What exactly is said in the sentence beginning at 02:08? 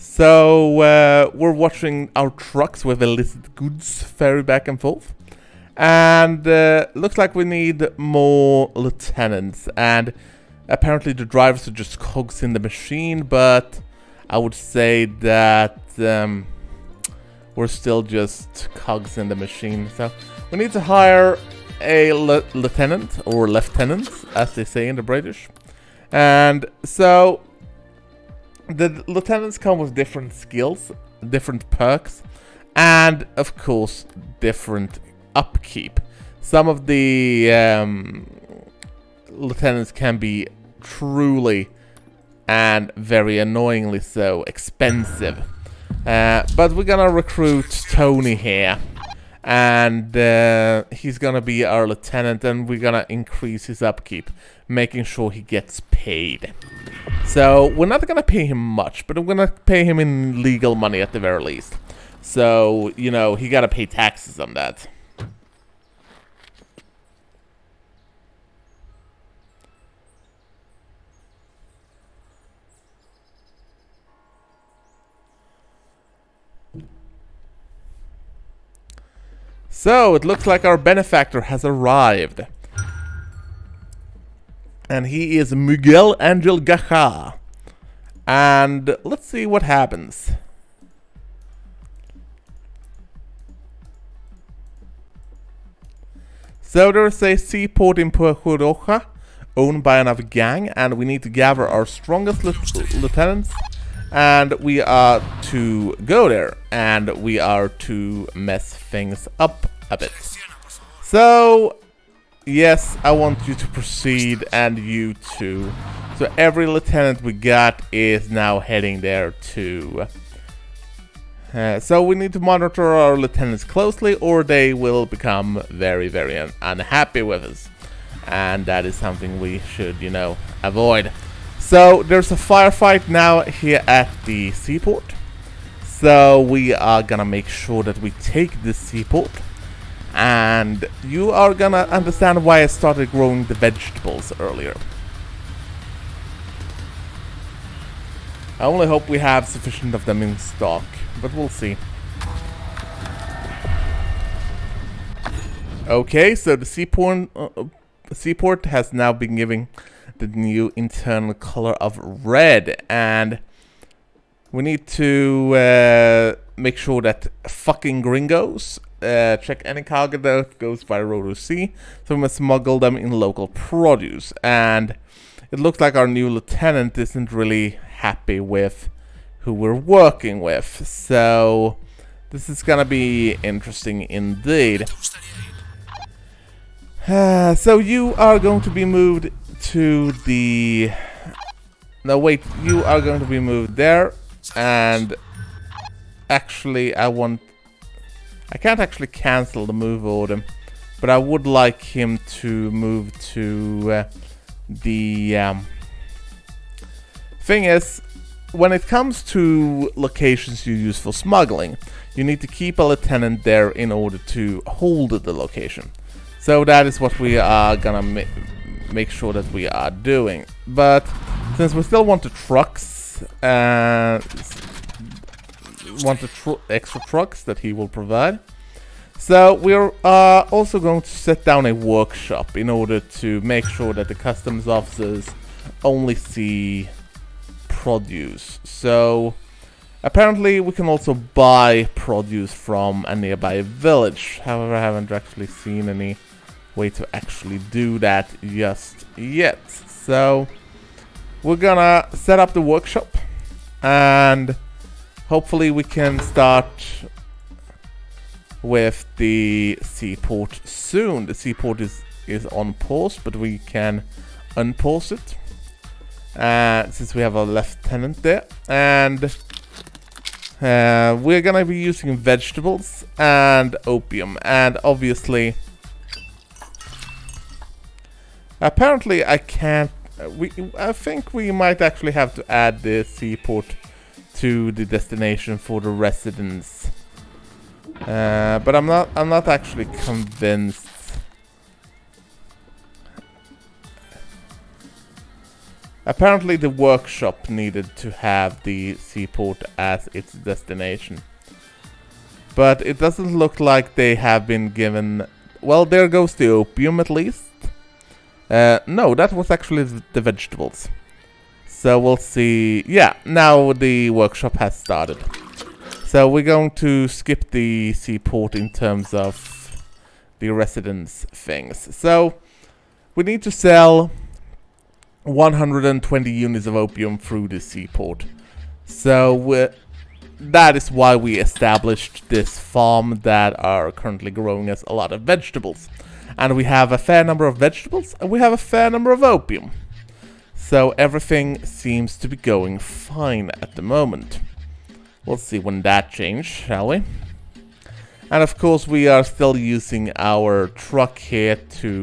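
And that is something we should, you know, avoid.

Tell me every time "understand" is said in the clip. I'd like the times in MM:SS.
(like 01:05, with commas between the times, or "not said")
02:21.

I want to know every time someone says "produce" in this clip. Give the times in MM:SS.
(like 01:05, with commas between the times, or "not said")
02:53, 03:57, 04:01.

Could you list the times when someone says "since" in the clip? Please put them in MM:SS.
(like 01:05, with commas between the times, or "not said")
03:41, 04:26.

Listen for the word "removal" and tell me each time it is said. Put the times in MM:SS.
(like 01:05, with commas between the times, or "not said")
not said.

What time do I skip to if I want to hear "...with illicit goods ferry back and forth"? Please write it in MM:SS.
00:02.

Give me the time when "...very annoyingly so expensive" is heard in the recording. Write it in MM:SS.
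00:42.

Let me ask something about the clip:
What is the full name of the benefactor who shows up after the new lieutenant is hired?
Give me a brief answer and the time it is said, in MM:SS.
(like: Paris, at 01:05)
Miguel Angel Gacha, at 01:25.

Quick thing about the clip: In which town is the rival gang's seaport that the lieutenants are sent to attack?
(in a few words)
Puerto Roja.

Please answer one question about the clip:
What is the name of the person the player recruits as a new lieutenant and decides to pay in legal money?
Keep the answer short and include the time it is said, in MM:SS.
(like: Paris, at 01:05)
Tony, at 00:47.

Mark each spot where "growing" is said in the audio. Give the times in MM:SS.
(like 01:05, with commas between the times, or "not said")
02:23, 05:34.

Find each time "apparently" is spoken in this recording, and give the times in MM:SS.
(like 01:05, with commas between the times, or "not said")
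00:10, 04:00, 04:38, 04:56.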